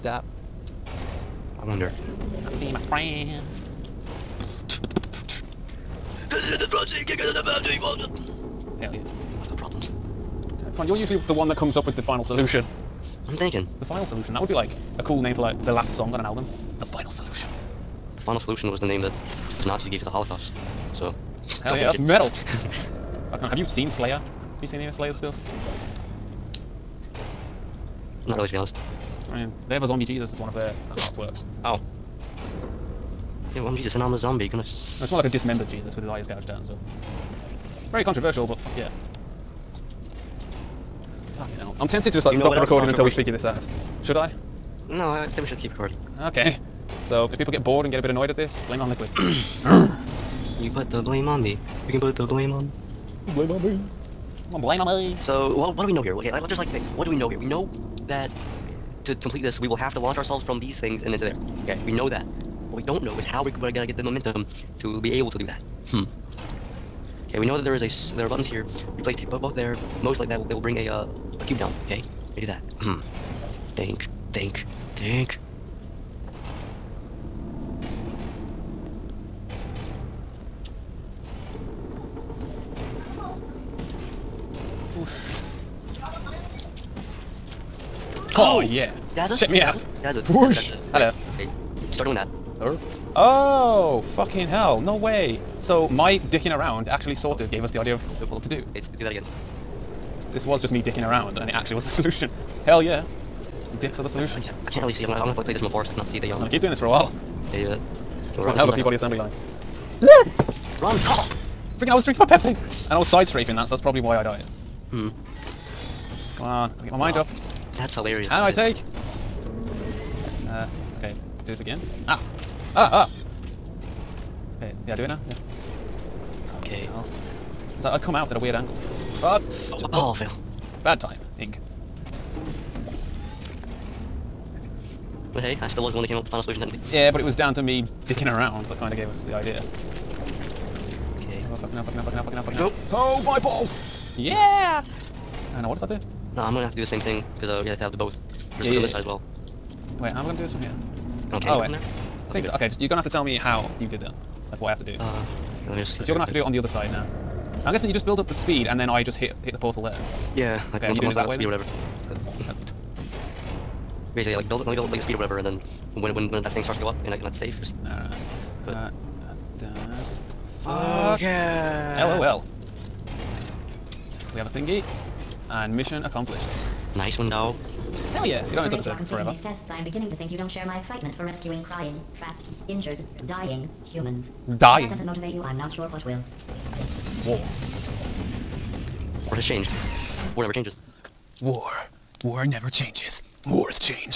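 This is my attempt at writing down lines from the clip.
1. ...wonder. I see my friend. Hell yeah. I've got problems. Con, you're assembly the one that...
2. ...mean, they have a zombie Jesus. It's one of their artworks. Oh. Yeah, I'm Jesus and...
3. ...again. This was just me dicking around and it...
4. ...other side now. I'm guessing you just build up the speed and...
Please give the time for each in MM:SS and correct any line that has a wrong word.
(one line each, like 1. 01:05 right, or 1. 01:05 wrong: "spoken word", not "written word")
1. 00:01 wrong: "usually", not "assembly"
2. 00:29 right
3. 01:39 right
4. 02:36 right.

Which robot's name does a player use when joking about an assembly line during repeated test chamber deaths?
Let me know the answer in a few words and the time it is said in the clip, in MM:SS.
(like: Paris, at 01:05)
P-body, at 01:48.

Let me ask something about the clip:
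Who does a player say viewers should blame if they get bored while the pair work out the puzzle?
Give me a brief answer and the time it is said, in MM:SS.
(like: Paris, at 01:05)
Liquid, at 00:48.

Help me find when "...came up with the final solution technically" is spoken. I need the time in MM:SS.
02:16.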